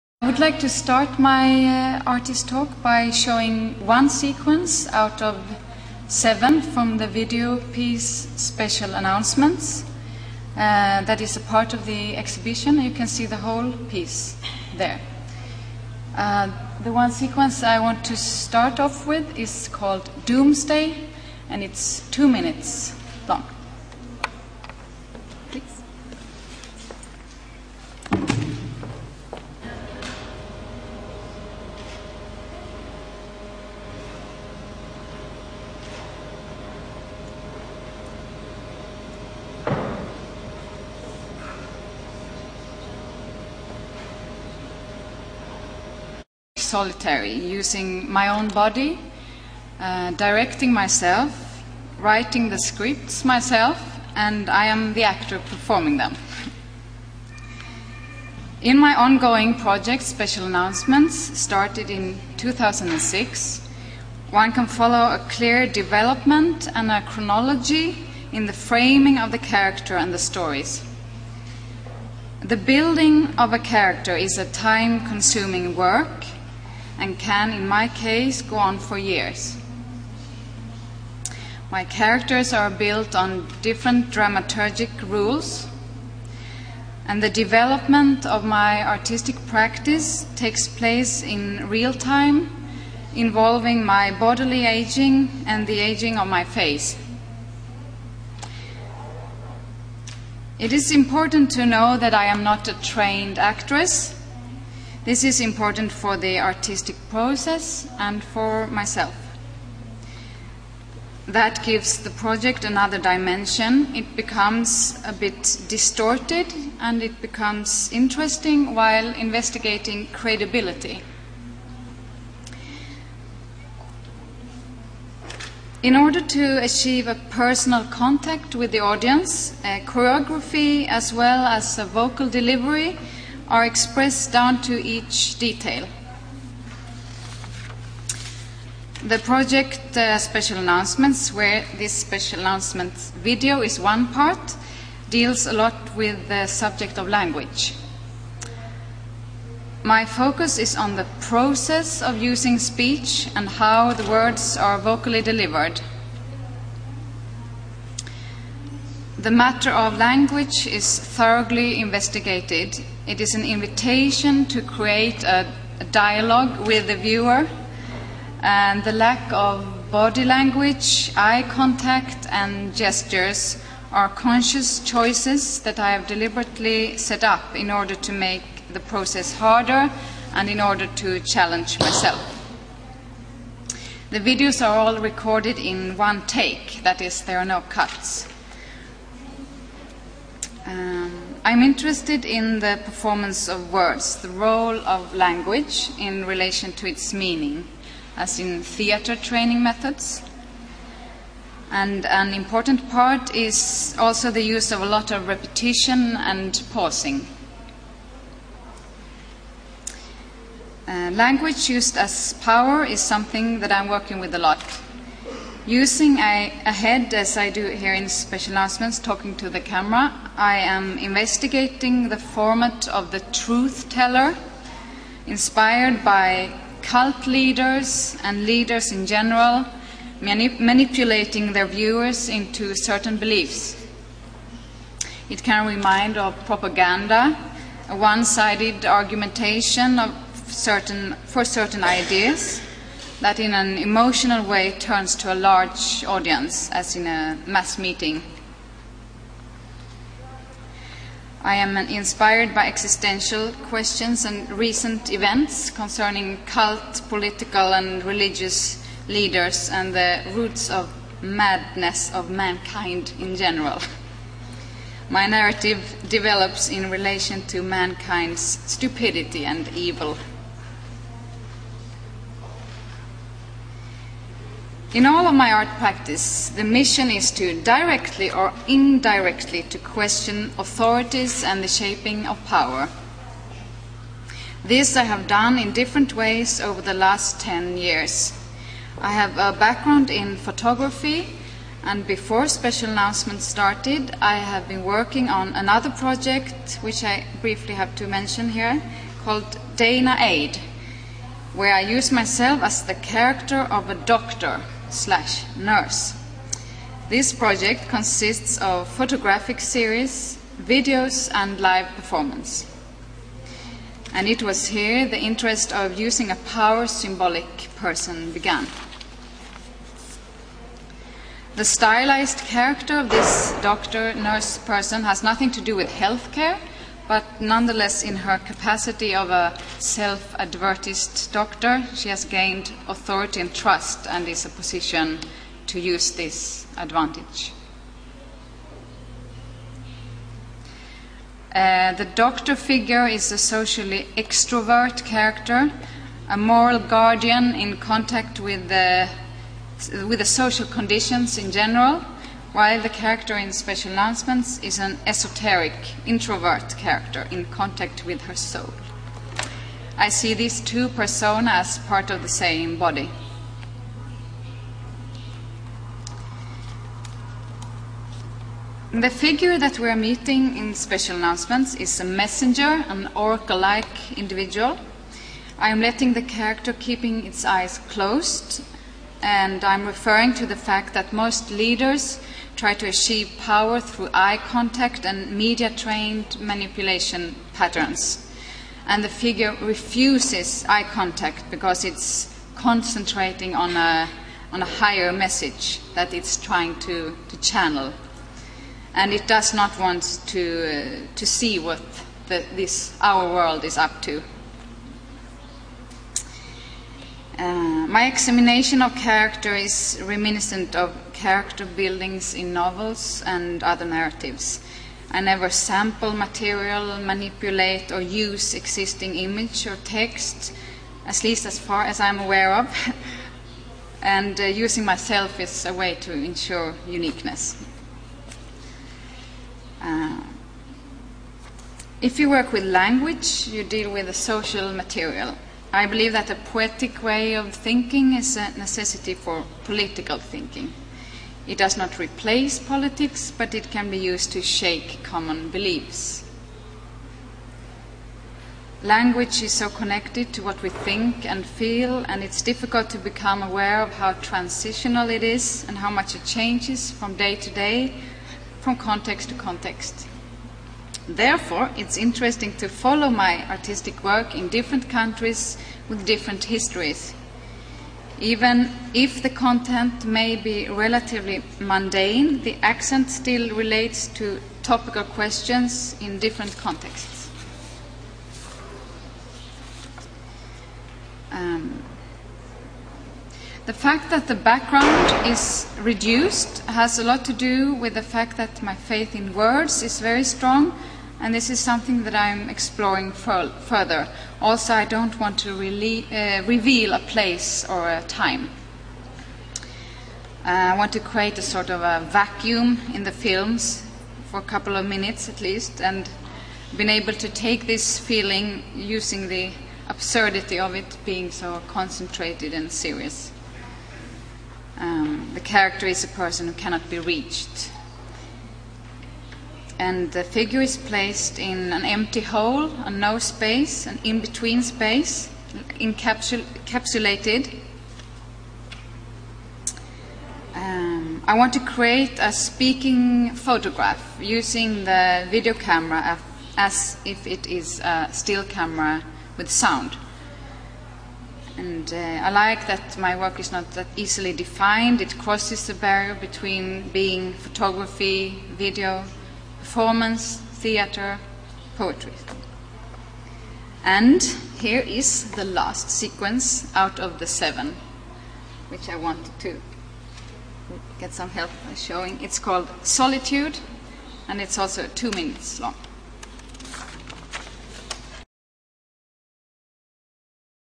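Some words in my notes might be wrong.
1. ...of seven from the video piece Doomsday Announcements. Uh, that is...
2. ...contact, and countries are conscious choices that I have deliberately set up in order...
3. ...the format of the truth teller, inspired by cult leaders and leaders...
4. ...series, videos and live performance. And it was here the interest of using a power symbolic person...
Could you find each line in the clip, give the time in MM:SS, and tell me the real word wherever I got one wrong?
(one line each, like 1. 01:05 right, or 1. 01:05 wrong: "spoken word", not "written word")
1. 00:05 wrong: "Special", not "Doomsday"
2. 02:51 wrong: "gestures", not "countries"
3. 03:42 right
4. 05:09 right.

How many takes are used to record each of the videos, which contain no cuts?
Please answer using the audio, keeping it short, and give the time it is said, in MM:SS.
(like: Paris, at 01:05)
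1, at 03:05.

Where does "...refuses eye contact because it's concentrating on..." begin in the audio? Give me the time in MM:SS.
06:29.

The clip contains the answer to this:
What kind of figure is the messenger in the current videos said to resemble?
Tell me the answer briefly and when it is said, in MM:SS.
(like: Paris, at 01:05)
Oracle-like, at 06:13.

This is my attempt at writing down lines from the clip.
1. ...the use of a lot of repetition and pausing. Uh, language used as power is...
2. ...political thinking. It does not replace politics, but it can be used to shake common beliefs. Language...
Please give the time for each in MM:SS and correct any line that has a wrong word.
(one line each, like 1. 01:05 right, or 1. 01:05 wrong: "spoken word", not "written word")
1. 03:24 right
2. 07:19 right.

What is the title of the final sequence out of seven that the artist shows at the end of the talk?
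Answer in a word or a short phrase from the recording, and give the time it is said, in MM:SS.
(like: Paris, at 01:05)
Solitude, at 09:22.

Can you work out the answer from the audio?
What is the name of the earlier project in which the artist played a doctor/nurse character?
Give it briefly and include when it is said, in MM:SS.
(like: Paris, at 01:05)
Dana Aid, at 04:59.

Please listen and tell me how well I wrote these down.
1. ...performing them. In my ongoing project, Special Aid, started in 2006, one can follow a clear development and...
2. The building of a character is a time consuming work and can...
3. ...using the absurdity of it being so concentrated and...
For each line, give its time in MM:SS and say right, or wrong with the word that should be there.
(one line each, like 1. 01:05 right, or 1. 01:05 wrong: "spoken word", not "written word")
1. 00:55 wrong: "Announcements", not "Aid"
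2. 01:12 right
3. 08:28 right.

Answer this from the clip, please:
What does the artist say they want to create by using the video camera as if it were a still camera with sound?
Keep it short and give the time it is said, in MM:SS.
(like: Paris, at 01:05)
A speaking photograph, at 08:52.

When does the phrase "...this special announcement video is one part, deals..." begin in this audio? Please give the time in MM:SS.
02:21.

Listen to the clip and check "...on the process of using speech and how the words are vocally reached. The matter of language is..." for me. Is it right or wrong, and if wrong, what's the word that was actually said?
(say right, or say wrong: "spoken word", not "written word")
wrong: "delivered", not "reached".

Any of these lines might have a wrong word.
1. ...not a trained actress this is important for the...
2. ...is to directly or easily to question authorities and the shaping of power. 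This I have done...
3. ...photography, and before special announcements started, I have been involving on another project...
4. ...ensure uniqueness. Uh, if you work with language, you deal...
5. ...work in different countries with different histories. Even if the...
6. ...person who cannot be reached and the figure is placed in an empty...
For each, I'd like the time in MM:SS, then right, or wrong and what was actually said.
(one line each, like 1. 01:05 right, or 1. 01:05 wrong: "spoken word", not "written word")
1. 01:42 right
2. 04:37 wrong: "indirectly", not "easily"
3. 04:50 wrong: "working", not "involving"
4. 07:06 right
5. 07:44 right
6. 08:36 right.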